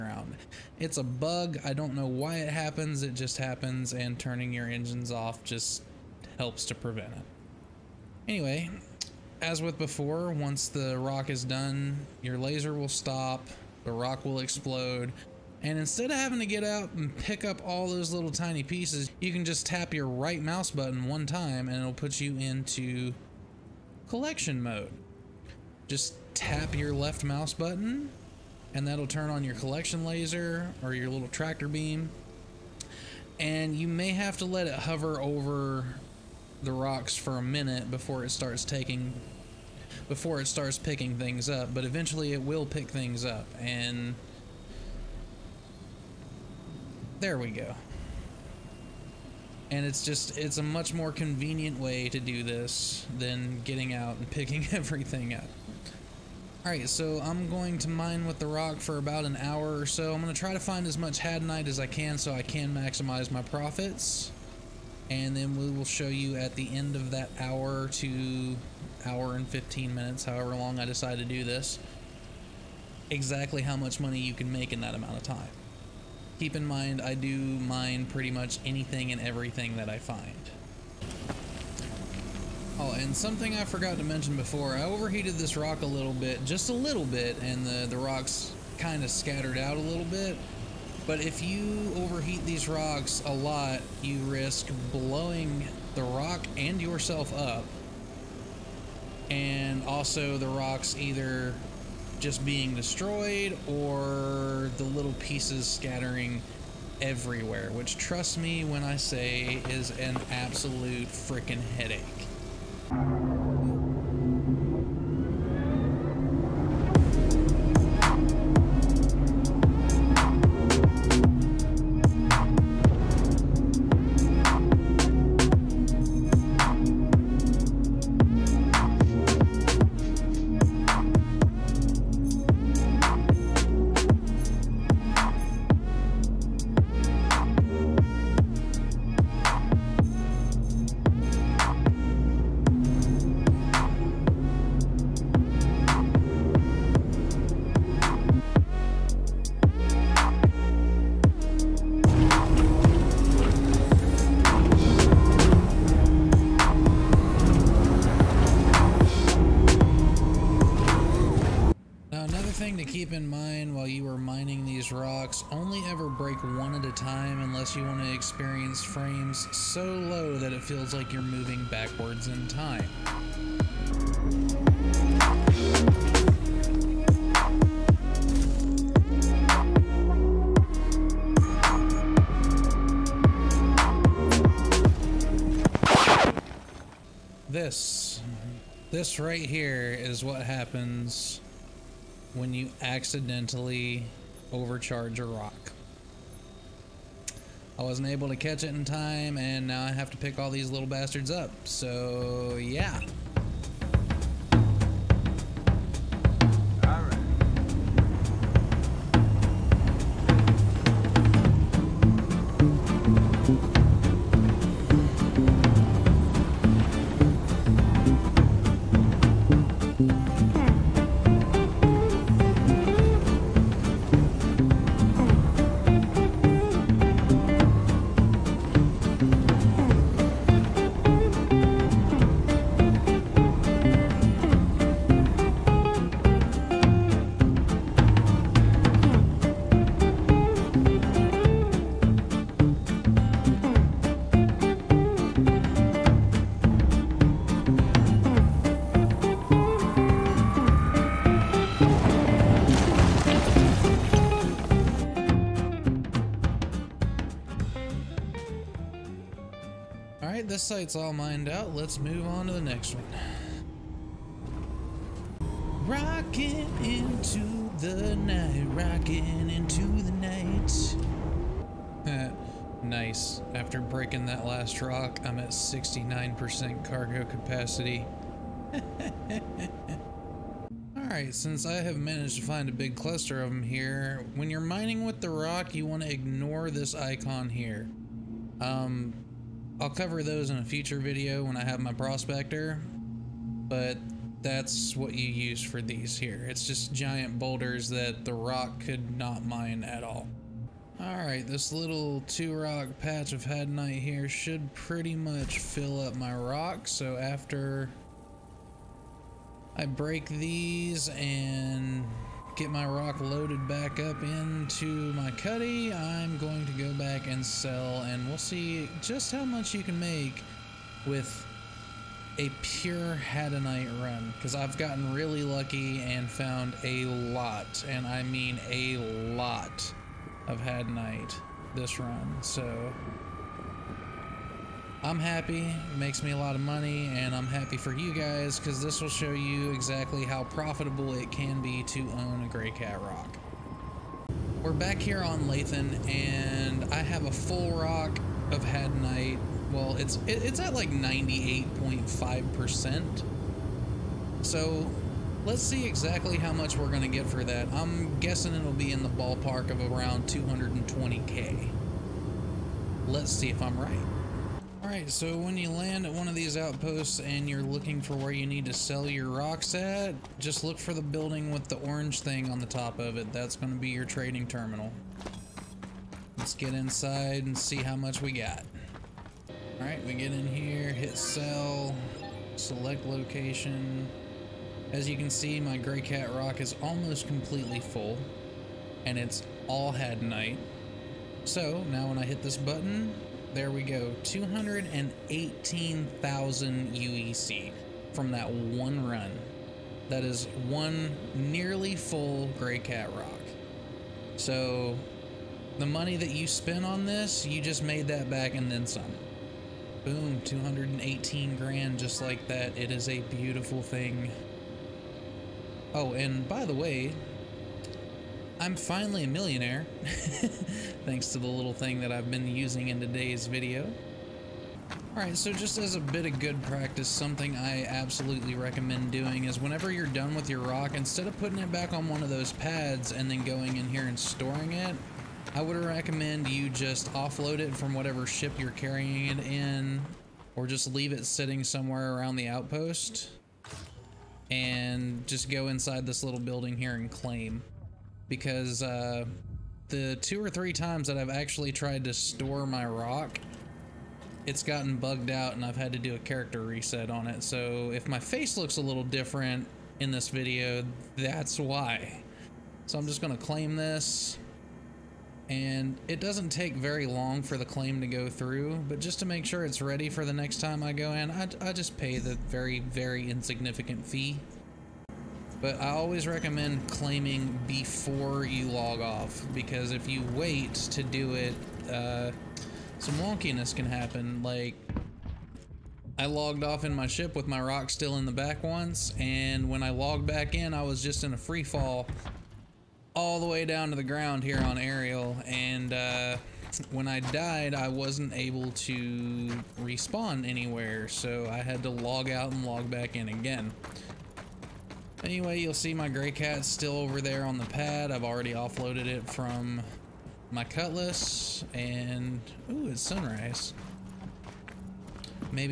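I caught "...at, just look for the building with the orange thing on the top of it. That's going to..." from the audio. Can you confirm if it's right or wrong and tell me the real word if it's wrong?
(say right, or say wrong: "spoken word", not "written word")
right.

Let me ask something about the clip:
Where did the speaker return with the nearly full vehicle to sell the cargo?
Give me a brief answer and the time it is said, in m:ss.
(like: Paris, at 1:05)
Lathan, at 5:45.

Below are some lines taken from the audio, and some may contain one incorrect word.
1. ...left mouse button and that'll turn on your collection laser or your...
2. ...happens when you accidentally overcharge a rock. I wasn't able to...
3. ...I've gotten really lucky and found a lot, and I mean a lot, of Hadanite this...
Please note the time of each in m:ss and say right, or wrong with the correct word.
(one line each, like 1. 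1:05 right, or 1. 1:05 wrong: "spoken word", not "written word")
1. 0:26 right
2. 3:10 right
3. 5:24 right.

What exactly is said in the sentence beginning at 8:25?
Anyway, you'll see my Greycat still over there on the pad.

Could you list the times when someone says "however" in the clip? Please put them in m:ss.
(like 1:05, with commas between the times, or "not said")
1:10.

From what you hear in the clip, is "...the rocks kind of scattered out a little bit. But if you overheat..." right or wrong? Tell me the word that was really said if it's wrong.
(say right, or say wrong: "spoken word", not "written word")
right.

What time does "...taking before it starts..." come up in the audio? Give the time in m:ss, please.
0:38.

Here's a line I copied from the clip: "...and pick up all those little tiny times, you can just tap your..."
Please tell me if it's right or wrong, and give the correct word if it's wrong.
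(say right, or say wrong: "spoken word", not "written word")
wrong: "pieces", not "times".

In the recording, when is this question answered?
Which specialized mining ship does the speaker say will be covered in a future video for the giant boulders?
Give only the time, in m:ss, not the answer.
4:51.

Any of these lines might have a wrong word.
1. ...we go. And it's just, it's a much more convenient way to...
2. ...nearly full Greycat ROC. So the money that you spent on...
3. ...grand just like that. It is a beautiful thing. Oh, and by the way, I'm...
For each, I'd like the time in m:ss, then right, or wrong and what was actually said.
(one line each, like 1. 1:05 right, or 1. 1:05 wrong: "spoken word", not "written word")
1. 0:47 right
2. 6:41 right
3. 6:51 right.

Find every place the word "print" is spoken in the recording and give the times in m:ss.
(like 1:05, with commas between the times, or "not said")
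not said.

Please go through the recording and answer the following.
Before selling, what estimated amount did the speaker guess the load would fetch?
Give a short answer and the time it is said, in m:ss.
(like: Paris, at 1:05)
220k, at 6:00.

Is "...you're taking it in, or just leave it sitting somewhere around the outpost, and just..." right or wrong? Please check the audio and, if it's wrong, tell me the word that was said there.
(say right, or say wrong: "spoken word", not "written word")
wrong: "carrying", not "taking".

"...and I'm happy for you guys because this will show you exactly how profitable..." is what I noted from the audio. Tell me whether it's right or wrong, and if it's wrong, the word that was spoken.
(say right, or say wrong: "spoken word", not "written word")
right.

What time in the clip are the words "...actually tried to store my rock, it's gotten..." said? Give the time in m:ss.
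7:31.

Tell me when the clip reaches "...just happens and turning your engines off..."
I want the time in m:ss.
0:03.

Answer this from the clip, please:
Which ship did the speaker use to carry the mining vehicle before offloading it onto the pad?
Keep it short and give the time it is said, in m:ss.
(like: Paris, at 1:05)
Cutlass, at 8:30.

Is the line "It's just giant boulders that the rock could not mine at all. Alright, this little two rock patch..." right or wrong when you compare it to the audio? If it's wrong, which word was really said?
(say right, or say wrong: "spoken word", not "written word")
right.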